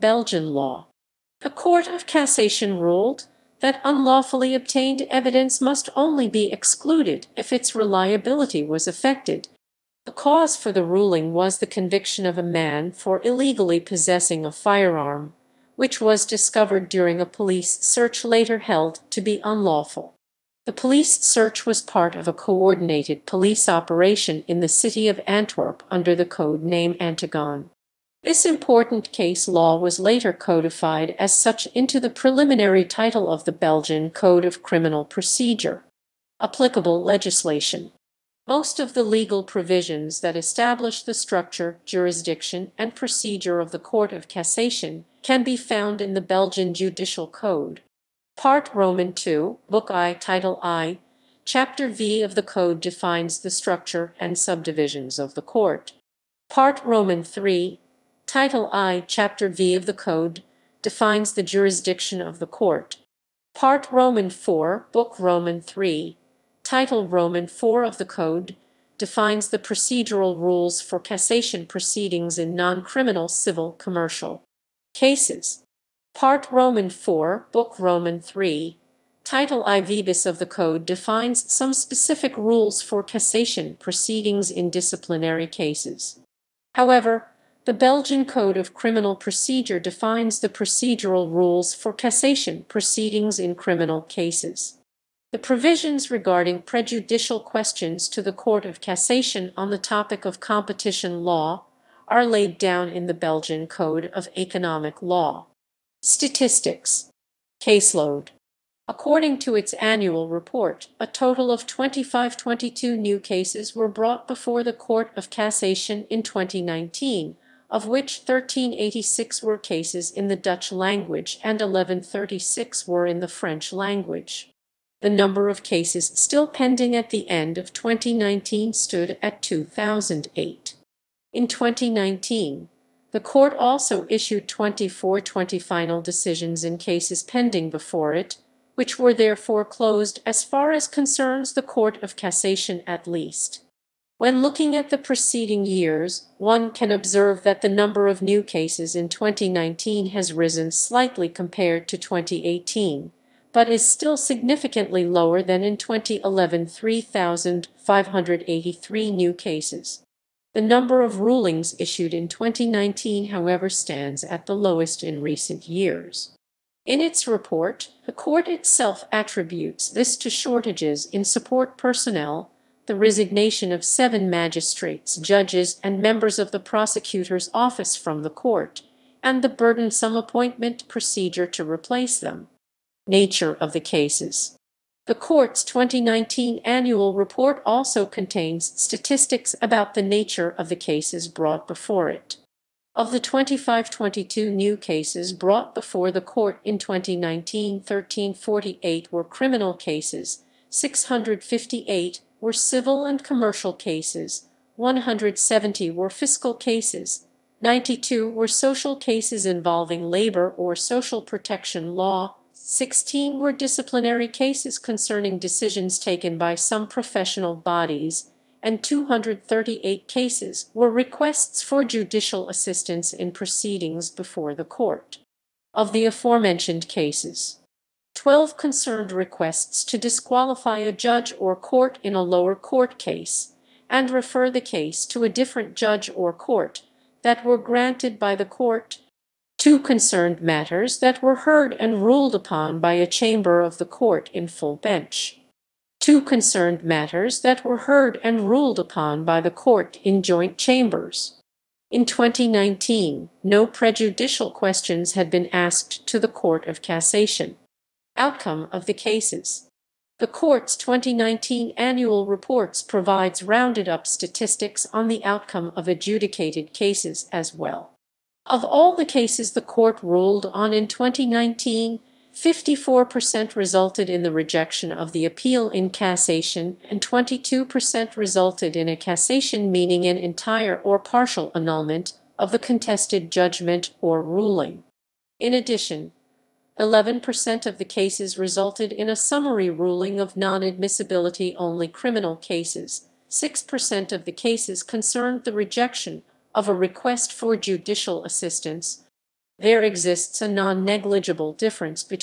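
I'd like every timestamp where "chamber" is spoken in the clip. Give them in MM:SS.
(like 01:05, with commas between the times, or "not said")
04:03, 04:10.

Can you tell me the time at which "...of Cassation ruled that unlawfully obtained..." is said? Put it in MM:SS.
00:01.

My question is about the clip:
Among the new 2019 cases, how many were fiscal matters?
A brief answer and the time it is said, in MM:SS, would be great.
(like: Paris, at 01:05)
170, at 03:24.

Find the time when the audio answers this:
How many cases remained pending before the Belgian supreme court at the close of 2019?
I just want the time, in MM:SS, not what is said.
02:09.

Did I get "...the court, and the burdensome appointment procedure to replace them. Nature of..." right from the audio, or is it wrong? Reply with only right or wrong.
right.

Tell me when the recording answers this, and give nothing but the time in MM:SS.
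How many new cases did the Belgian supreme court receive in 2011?
02:36.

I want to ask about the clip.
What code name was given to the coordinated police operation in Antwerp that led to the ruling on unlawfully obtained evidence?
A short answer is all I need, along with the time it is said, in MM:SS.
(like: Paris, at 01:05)
Antigone, at 00:27.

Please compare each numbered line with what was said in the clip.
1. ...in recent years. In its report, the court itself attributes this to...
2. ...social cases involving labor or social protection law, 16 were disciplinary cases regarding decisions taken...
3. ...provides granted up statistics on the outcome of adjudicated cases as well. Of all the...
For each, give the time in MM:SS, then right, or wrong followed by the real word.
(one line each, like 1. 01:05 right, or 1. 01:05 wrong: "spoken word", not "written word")
1. 02:45 right
2. 03:28 wrong: "concerning", not "regarding"
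3. 04:22 wrong: "rounded", not "granted".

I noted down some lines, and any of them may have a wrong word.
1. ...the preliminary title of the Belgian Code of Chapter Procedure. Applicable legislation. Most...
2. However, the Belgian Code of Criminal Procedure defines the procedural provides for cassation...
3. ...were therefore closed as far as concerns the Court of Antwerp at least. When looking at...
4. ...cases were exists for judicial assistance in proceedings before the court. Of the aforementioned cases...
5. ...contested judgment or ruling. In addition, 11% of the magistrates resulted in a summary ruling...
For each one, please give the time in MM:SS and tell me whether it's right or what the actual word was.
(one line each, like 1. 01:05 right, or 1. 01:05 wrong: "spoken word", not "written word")
1. 00:31 wrong: "Criminal", not "Chapter"
2. 01:26 wrong: "rules", not "provides"
3. 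02:18 wrong: "Cassation", not "Antwerp"
4. 03:40 wrong: "requests", not "exists"
5. 04:42 wrong: "cases", not "magistrates".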